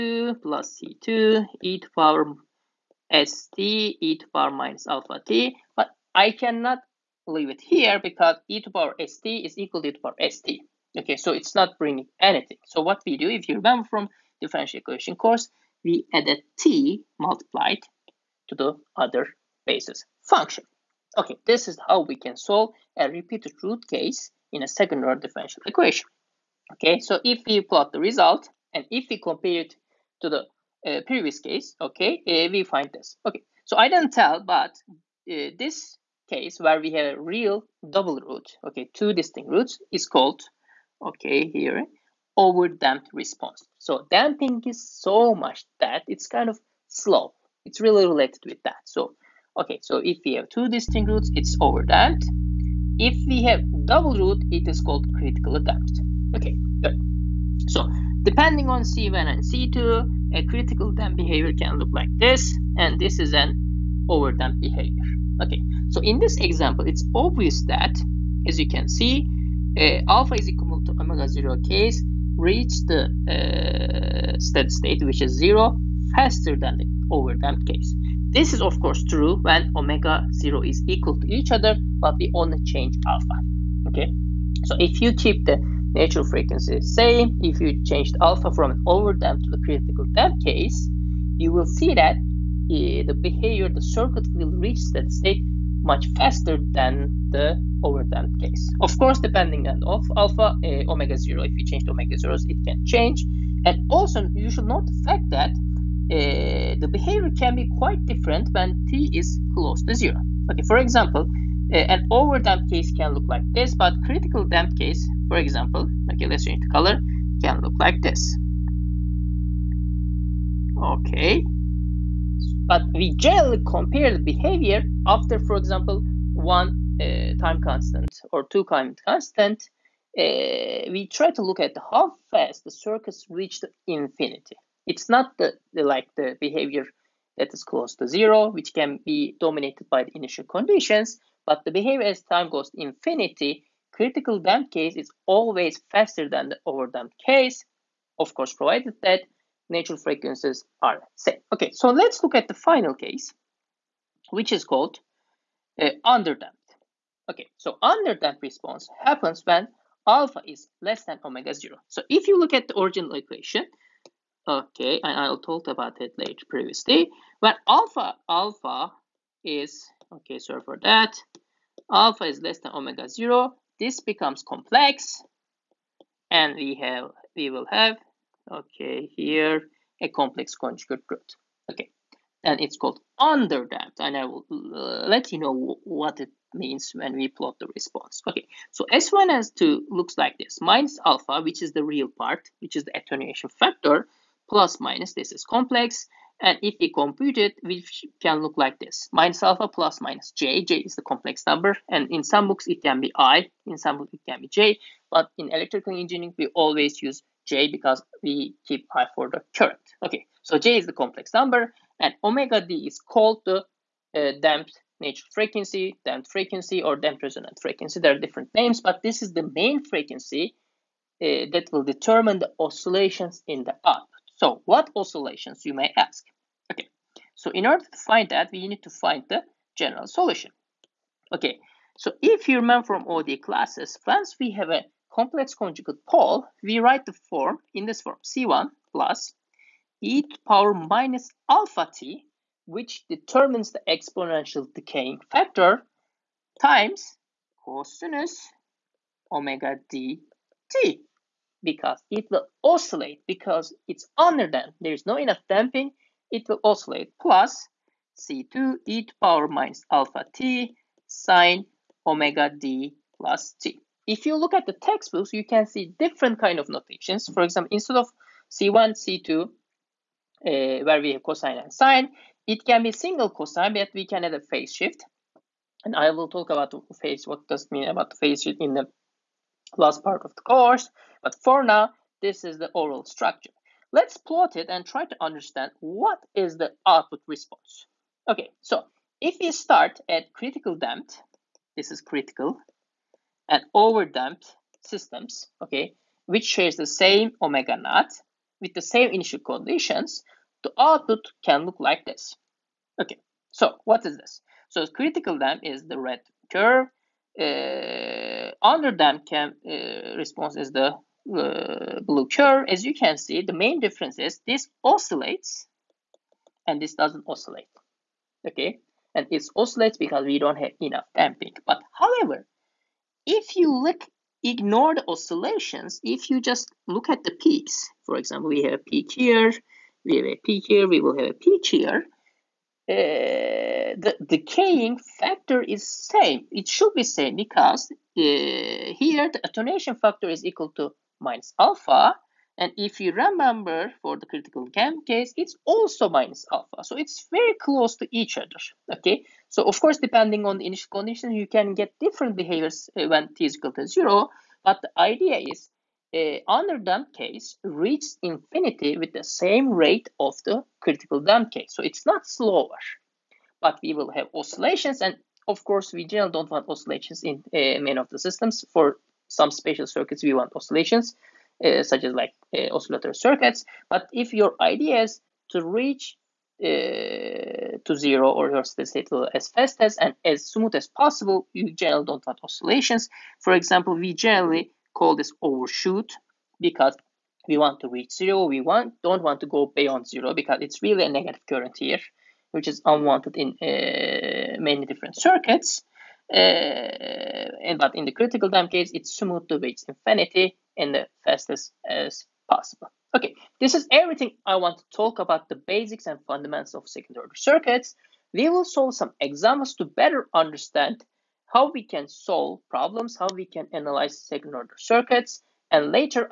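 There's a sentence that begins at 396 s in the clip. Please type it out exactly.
Uh, eh, but in the critical time case, it's smooth to reach infinity in the fastest as possible.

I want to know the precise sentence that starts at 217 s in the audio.
There are different names, but this is the main frequency uh, that will determine the oscillations in the up.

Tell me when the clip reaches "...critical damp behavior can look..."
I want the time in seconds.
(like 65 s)
60 s.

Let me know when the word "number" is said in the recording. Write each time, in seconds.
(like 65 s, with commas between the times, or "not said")
201 s, 211 s.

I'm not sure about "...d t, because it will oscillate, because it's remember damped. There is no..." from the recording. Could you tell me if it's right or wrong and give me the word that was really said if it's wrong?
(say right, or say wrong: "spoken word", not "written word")
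wrong: "under", not "remember".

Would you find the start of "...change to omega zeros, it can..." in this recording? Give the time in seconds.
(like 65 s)
101 s.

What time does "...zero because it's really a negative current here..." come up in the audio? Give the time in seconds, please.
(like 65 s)
390 s.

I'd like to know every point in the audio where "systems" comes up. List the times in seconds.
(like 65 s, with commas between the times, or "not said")
294 s, 368 s.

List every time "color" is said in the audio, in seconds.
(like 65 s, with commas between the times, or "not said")
116 s.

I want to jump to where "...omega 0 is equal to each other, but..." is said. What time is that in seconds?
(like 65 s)
79 s.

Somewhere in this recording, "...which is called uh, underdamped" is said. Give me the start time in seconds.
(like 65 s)
154 s.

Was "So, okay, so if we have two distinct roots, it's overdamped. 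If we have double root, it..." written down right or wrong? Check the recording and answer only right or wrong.
right.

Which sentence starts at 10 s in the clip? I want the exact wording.
Okay, so it's not bringing anything.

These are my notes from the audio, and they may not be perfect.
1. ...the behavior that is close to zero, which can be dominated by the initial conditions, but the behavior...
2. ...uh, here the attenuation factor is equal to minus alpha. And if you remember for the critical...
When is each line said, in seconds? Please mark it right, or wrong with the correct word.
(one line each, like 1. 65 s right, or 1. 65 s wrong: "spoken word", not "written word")
1. 136 s right
2. 337 s right.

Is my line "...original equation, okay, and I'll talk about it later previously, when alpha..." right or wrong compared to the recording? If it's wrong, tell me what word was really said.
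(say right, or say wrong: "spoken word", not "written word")
right.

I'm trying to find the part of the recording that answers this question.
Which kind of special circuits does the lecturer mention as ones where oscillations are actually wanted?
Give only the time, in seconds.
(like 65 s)
372 s.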